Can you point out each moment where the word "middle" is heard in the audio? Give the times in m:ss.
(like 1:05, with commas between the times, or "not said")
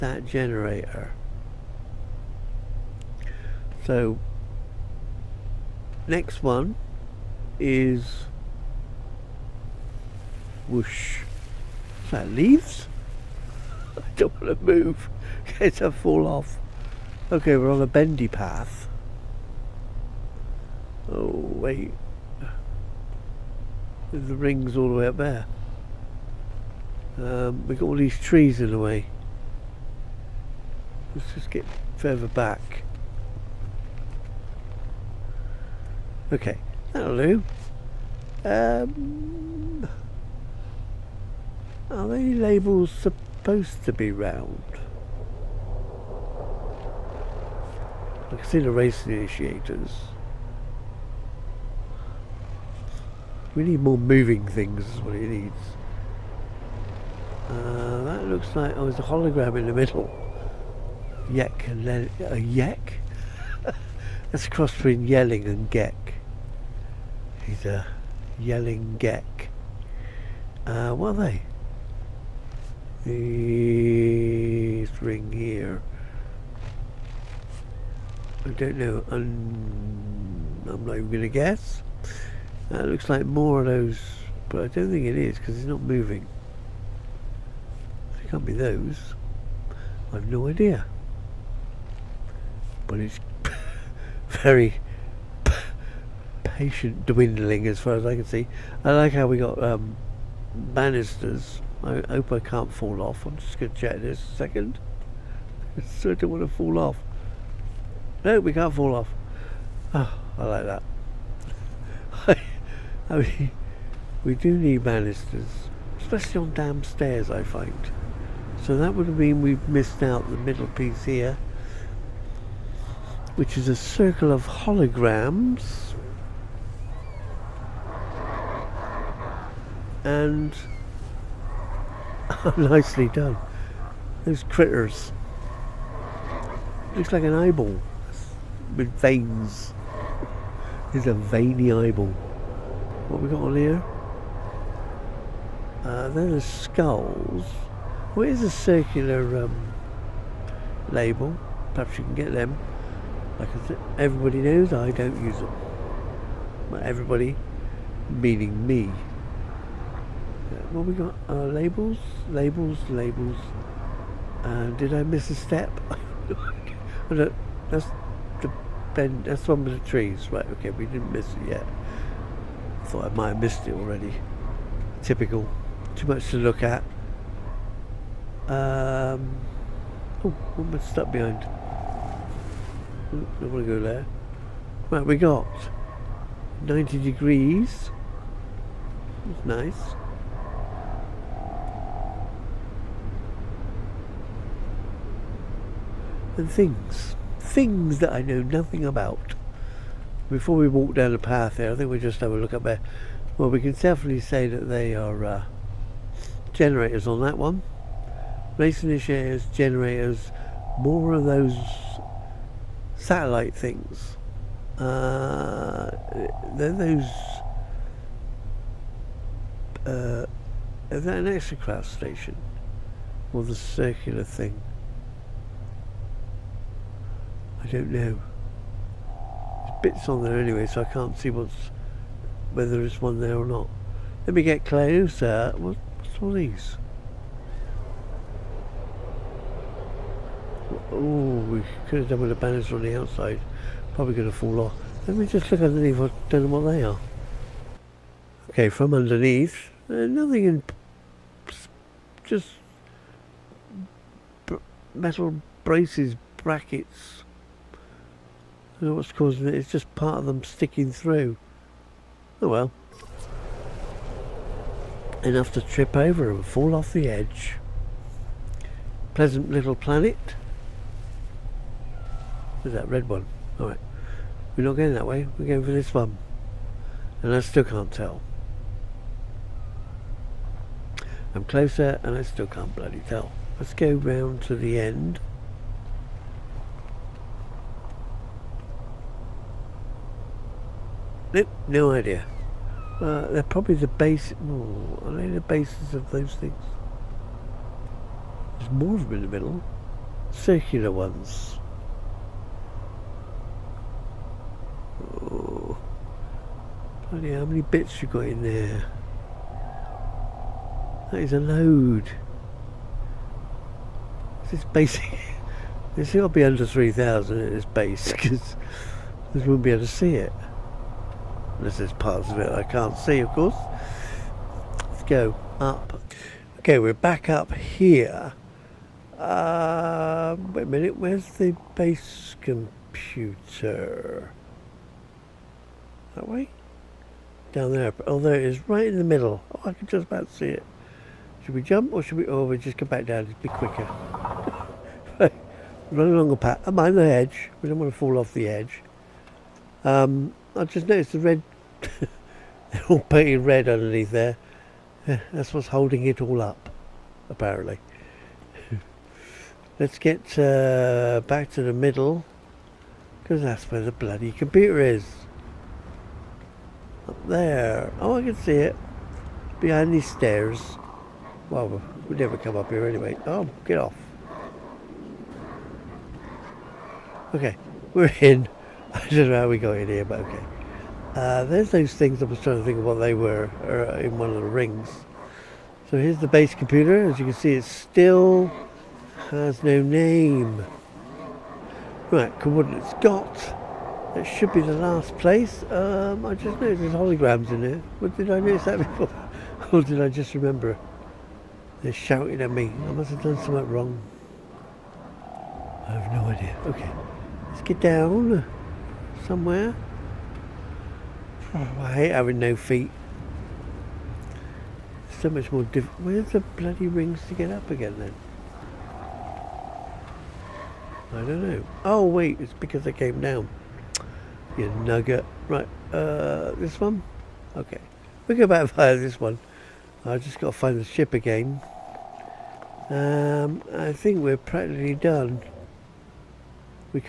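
0:59, 2:00, 4:59, 5:39, 6:01.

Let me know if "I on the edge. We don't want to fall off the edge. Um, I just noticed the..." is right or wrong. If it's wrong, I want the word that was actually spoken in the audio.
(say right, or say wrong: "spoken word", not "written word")
right.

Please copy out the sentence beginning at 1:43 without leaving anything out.
I'm just going to check this a second.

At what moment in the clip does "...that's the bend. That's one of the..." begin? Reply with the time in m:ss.
2:47.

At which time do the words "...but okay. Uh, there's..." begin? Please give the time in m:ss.
6:20.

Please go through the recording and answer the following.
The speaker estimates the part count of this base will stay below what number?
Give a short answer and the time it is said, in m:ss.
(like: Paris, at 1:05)
3,000, at 5:16.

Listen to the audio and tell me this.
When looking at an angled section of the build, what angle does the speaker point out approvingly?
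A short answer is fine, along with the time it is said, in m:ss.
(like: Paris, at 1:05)
90 degrees, at 3:06.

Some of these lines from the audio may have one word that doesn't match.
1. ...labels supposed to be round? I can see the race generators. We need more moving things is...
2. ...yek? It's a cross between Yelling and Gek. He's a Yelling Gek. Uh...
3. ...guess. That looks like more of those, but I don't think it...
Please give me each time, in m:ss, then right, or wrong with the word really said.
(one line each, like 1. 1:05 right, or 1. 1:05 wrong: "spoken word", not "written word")
1. 0:42 wrong: "initiators", not "generators"
2. 1:02 right
3. 1:21 right.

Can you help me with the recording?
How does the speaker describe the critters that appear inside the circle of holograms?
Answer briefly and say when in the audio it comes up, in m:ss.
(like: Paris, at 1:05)
veiny eyeball, at 2:21.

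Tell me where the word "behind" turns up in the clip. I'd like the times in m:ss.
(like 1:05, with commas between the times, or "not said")
3:01, 6:09.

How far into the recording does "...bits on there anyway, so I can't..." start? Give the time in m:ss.
3:49.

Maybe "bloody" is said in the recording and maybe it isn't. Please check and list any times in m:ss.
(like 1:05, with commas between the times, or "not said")
4:42, 5:07, 6:03, 6:56.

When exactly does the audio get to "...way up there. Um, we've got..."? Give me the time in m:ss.
0:24.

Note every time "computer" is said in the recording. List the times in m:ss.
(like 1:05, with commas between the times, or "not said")
5:32, 6:04, 6:26.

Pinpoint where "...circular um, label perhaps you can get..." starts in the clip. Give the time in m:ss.
2:28.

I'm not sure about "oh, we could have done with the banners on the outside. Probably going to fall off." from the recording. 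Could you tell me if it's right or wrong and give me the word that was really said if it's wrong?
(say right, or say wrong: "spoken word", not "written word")
right.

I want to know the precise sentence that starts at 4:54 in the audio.
Oh, are they the bases of those things?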